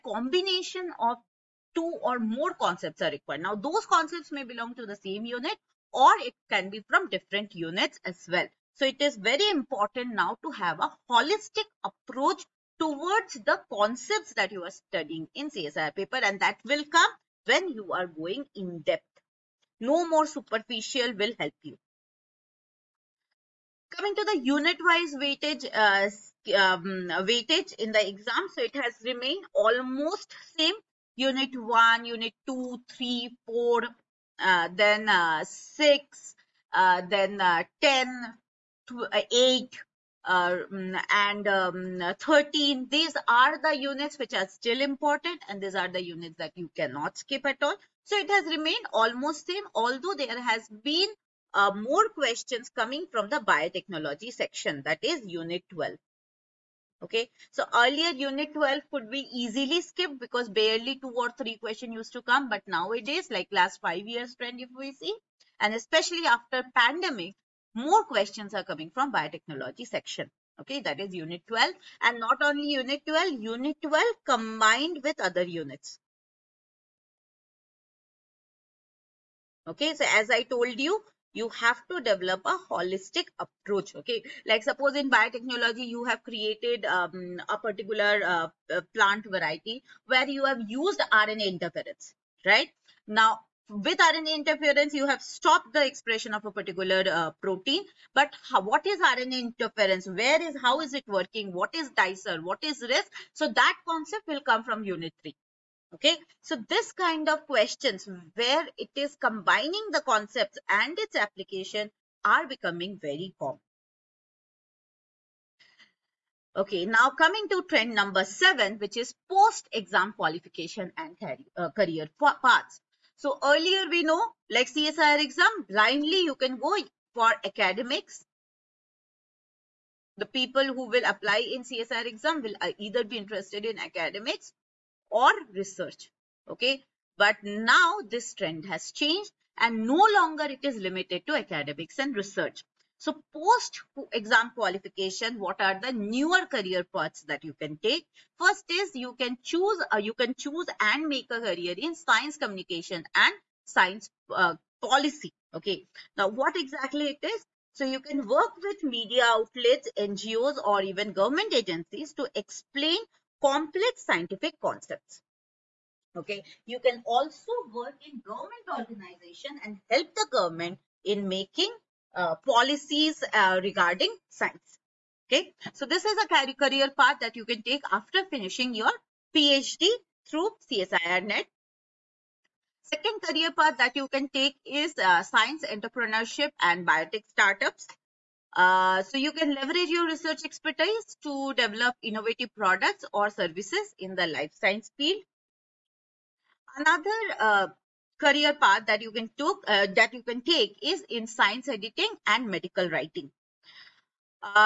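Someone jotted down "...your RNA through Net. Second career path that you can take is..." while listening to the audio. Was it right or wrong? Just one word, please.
wrong.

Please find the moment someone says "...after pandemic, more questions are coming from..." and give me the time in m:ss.
1:06.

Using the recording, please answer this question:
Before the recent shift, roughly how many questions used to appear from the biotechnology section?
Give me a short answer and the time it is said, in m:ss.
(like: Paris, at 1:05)
two or three, at 1:00.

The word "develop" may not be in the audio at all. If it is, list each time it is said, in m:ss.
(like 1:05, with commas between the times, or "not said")
1:22, 3:11.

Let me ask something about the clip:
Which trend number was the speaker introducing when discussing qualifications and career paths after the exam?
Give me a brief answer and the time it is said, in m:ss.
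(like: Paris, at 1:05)
7, at 1:57.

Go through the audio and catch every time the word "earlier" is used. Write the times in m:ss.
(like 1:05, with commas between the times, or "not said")
0:57, 2:03.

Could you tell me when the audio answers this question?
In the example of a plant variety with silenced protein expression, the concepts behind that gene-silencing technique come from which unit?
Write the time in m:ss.
1:44.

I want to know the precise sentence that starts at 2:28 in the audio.
First is you can choose, uh, you can choose and make a career in science communication and science uh, policy.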